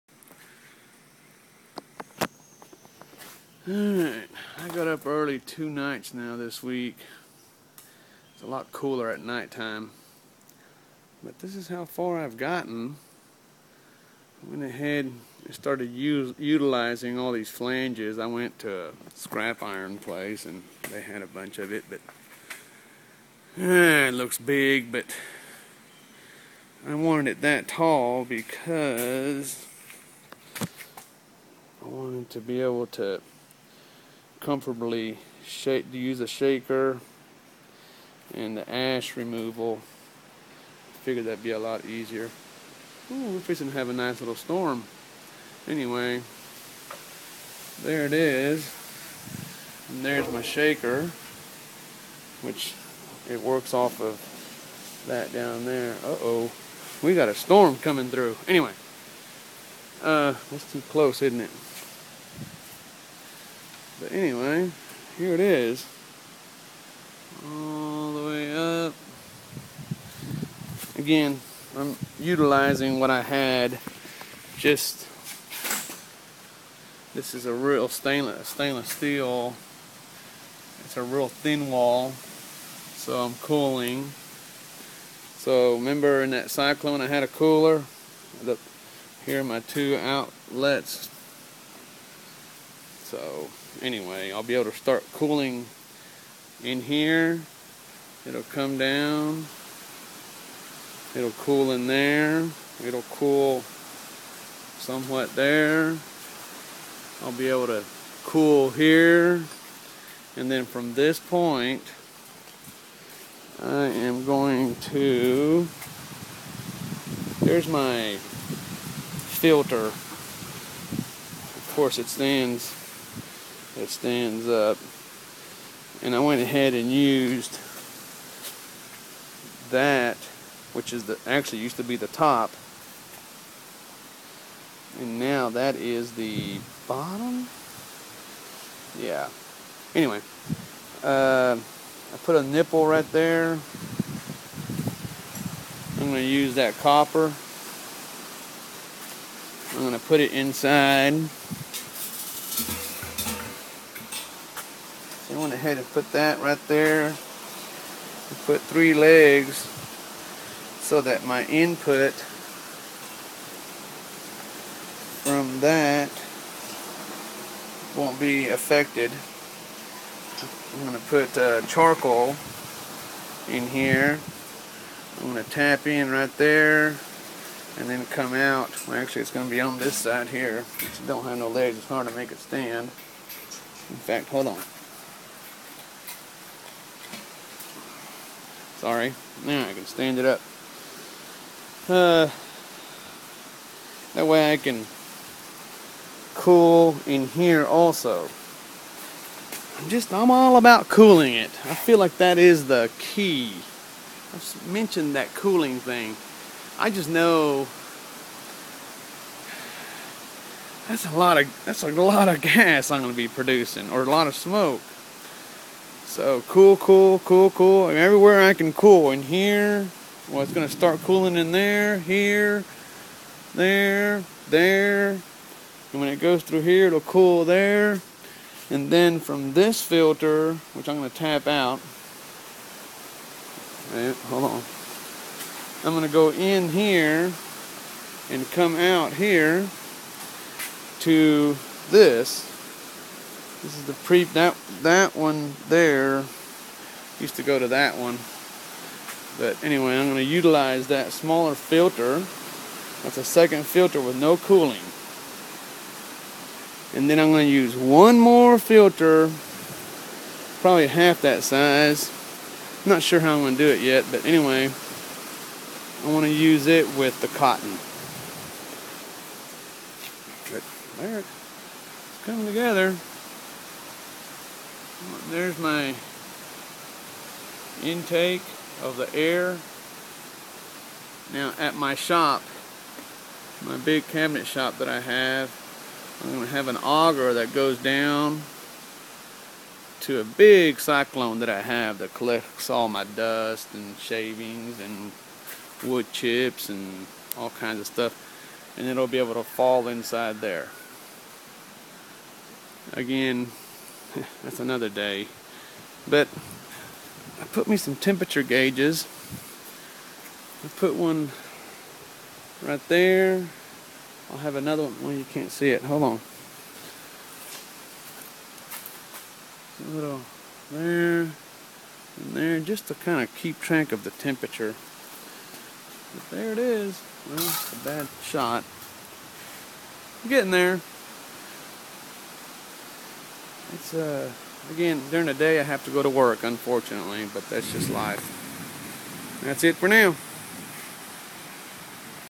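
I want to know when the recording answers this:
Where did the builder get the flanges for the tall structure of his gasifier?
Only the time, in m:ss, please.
0:19.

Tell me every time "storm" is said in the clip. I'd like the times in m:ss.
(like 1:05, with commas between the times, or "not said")
0:44, 0:57.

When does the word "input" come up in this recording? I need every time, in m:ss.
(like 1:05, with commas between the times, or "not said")
2:41.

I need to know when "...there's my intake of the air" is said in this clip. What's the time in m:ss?
4:35.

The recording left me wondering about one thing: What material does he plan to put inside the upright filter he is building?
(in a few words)
Charcoal.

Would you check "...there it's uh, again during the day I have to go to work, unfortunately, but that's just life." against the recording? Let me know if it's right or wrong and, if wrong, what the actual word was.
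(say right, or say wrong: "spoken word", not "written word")
right.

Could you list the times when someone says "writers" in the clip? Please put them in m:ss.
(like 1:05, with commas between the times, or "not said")
not said.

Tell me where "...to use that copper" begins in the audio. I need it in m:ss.
2:26.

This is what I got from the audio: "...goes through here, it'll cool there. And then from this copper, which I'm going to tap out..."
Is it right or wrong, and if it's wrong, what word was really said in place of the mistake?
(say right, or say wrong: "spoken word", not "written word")
wrong: "filter", not "copper".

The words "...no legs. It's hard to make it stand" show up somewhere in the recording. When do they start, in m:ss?
3:01.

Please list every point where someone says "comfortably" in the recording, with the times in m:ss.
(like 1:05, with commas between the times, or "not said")
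0:34.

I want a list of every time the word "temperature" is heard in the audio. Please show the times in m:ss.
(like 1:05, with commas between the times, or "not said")
5:07, 5:24.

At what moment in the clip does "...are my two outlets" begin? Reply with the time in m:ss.
1:29.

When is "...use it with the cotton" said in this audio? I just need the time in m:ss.
4:26.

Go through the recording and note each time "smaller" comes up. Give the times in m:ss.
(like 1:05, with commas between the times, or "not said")
4:11.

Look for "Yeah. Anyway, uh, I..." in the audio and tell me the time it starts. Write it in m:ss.
2:18.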